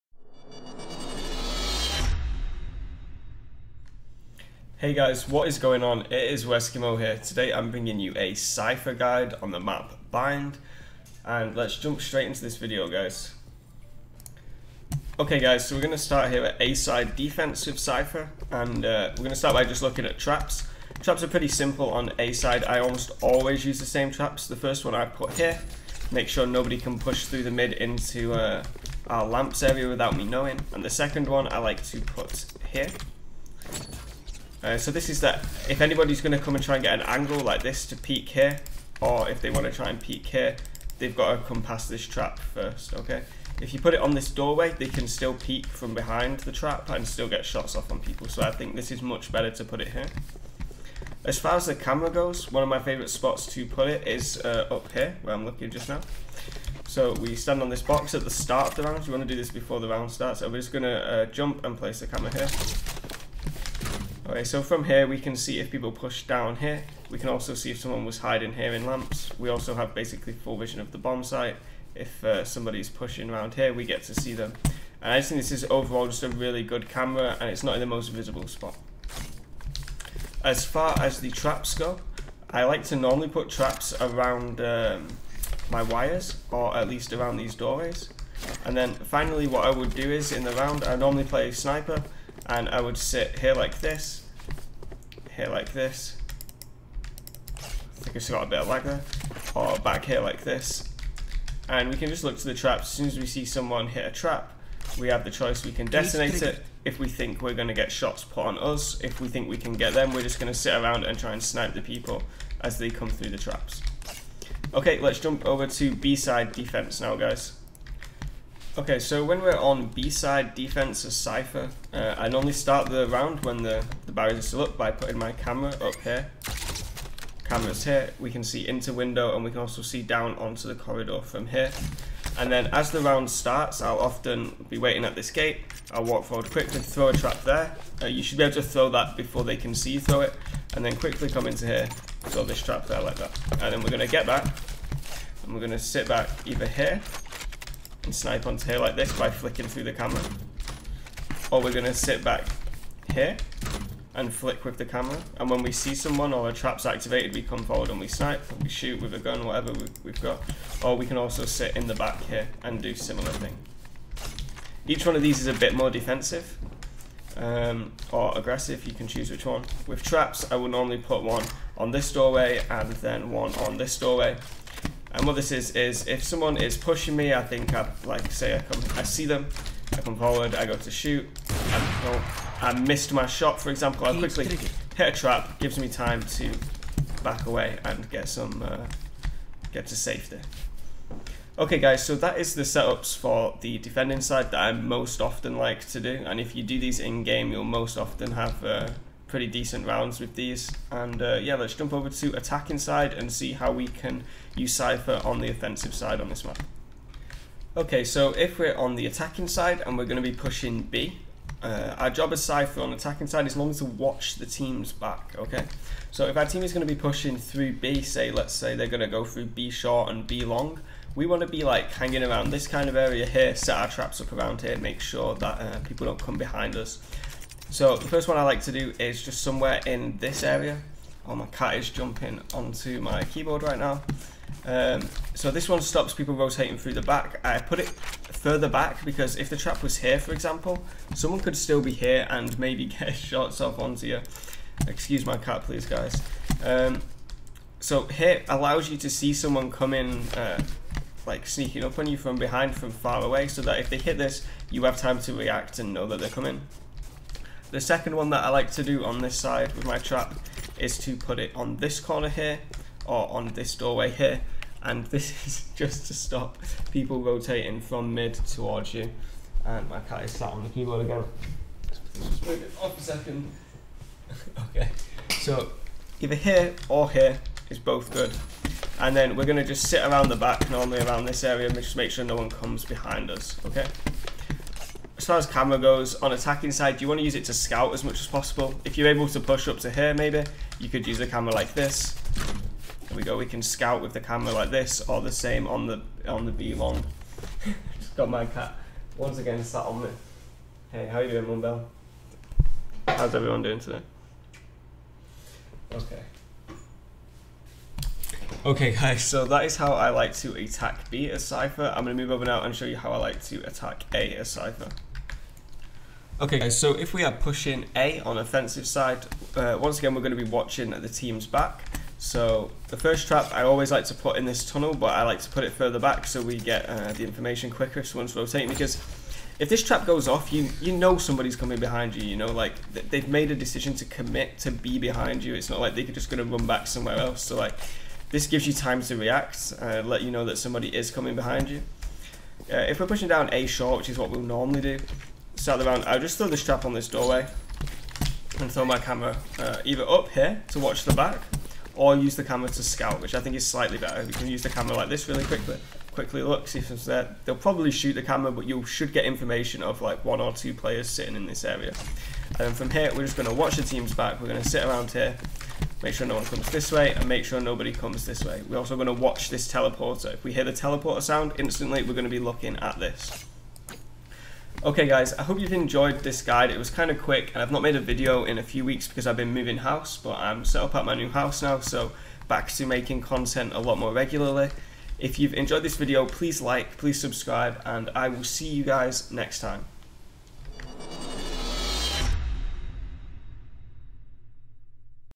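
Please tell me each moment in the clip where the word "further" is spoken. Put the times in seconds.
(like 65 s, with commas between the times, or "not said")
237 s, 325 s.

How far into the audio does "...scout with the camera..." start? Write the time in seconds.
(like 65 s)
293 s.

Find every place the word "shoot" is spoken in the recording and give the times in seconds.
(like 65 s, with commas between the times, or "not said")
158 s, 180 s, 357 s.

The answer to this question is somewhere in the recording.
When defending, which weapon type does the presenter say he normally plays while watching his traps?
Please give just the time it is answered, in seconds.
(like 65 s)
91 s.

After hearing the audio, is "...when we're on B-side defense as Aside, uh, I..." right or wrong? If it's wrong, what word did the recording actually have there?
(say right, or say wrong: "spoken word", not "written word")
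wrong: "Cypher", not "Aside".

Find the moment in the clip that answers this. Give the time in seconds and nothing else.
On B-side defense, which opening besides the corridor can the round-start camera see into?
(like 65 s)
128 s.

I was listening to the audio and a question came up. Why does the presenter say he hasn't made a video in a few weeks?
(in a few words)
moving house.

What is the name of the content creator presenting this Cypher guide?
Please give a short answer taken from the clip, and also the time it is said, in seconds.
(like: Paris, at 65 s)
Weskimo, at 6 s.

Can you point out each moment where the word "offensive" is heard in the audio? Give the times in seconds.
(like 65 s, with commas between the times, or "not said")
205 s, 318 s.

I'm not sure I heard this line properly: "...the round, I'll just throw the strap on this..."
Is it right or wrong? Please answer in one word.
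right.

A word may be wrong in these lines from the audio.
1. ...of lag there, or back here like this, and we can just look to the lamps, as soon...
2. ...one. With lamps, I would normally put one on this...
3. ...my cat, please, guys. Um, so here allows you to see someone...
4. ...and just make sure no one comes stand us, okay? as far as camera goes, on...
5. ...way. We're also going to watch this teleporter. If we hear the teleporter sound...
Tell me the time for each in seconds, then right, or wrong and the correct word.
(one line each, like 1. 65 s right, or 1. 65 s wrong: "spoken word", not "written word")
1. 98 s wrong: "traps", not "lamps"
2. 169 s wrong: "traps", not "lamps"
3. 245 s right
4. 281 s wrong: "behind", not "stand"
5. 368 s right.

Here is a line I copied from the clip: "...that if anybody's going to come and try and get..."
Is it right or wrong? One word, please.
right.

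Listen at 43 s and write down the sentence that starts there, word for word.
If you put it on this doorway, they can still peek from behind the trap and still get shots off on people.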